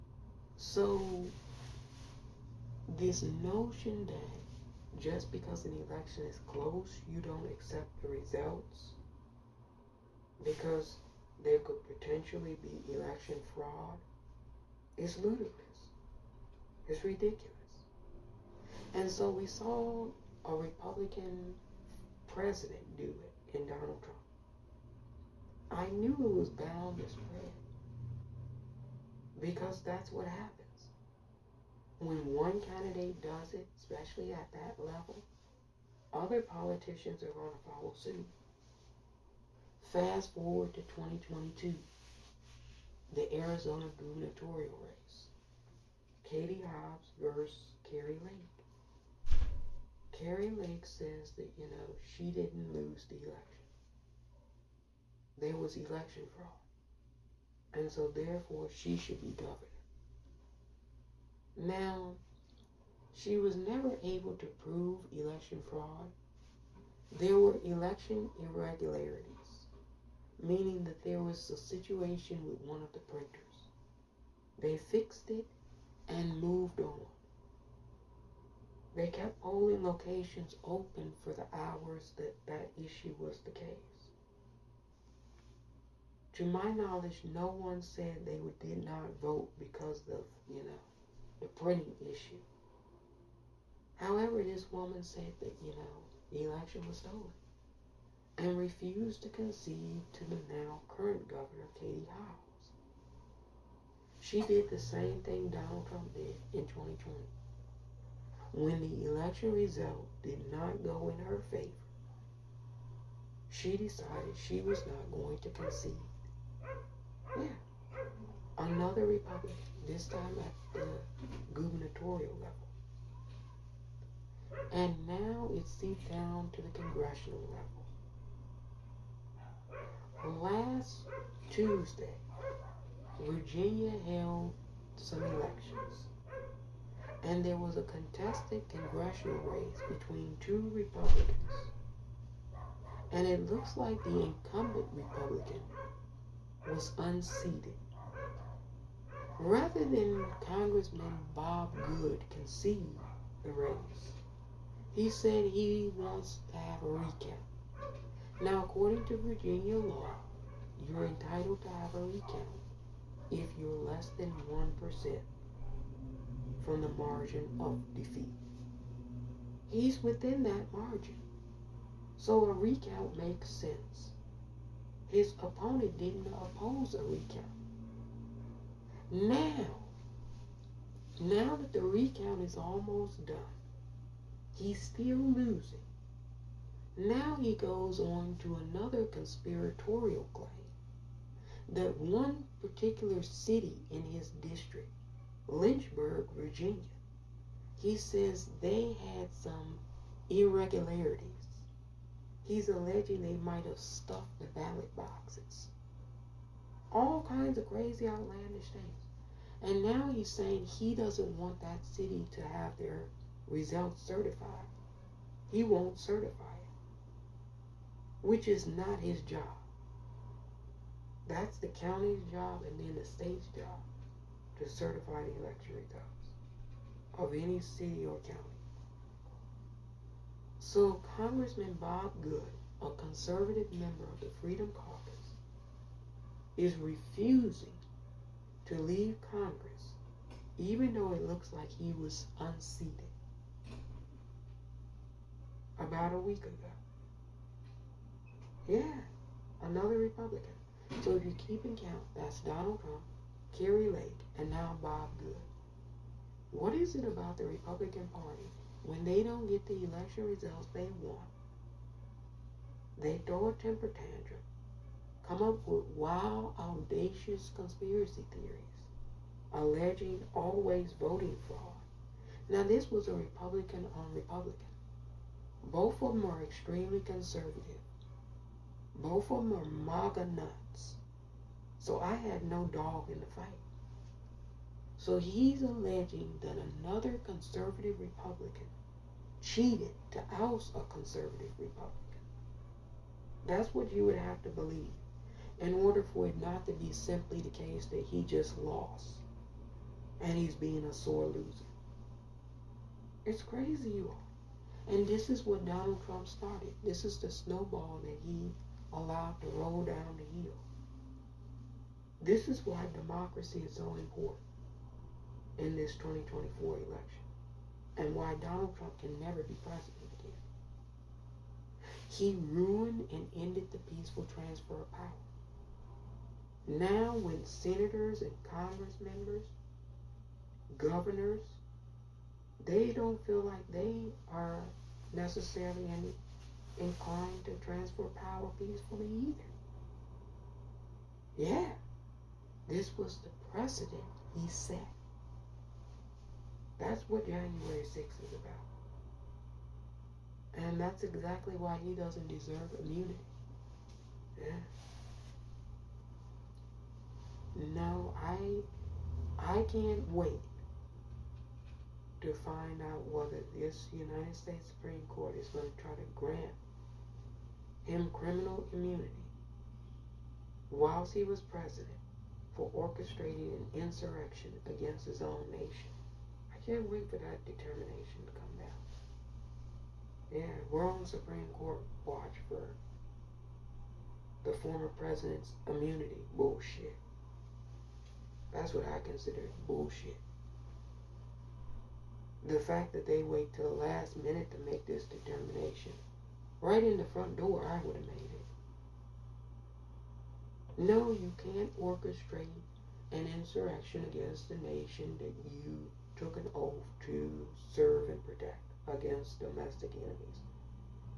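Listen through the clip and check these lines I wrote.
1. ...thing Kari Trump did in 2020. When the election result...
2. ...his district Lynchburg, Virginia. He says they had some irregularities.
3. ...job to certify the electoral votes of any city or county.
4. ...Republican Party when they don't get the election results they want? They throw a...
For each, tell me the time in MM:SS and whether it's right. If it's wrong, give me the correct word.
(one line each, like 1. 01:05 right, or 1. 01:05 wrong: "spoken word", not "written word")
1. 01:45 wrong: "Donald", not "Kari"
2. 03:14 right
3. 03:43 right
4. 04:17 right.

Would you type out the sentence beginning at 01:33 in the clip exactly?
However, this woman said that, you know, the election was stolen and refused to concede to the now current governor, Katie Hobbs.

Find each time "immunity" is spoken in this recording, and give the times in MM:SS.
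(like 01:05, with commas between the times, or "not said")
05:52, 06:08, 06:25.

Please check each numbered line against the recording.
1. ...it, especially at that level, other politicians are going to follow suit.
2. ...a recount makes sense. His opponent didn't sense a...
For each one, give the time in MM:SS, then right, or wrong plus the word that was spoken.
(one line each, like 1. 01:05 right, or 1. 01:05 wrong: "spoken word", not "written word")
1. 00:33 right
2. 02:52 wrong: "oppose", not "sense".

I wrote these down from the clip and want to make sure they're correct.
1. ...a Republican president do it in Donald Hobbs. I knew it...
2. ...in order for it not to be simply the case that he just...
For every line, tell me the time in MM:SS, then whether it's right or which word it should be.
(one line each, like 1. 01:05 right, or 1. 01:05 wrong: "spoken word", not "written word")
1. 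00:20 wrong: "Trump", not "Hobbs"
2. 04:55 right.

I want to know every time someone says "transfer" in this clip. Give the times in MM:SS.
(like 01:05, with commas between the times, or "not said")
05:24, 05:37.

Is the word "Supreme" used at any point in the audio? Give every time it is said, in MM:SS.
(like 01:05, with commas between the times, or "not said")
06:04, 06:21.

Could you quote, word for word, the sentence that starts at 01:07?
There were election irregularities, meaning that there was a situation with one of the printers.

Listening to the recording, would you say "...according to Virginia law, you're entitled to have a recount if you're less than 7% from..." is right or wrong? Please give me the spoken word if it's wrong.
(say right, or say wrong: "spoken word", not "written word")
wrong: "1", not "7".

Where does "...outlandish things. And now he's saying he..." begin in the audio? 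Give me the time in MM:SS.
03:28.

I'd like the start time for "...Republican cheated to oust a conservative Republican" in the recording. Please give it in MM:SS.
04:48.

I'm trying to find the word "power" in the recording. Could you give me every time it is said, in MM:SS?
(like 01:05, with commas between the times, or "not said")
05:24, 05:38.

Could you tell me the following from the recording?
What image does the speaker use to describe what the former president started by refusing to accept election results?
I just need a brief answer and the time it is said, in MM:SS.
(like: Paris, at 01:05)
snowball, at 05:07.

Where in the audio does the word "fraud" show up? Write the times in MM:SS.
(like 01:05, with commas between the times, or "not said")
00:13, 00:56, 01:05, 04:31.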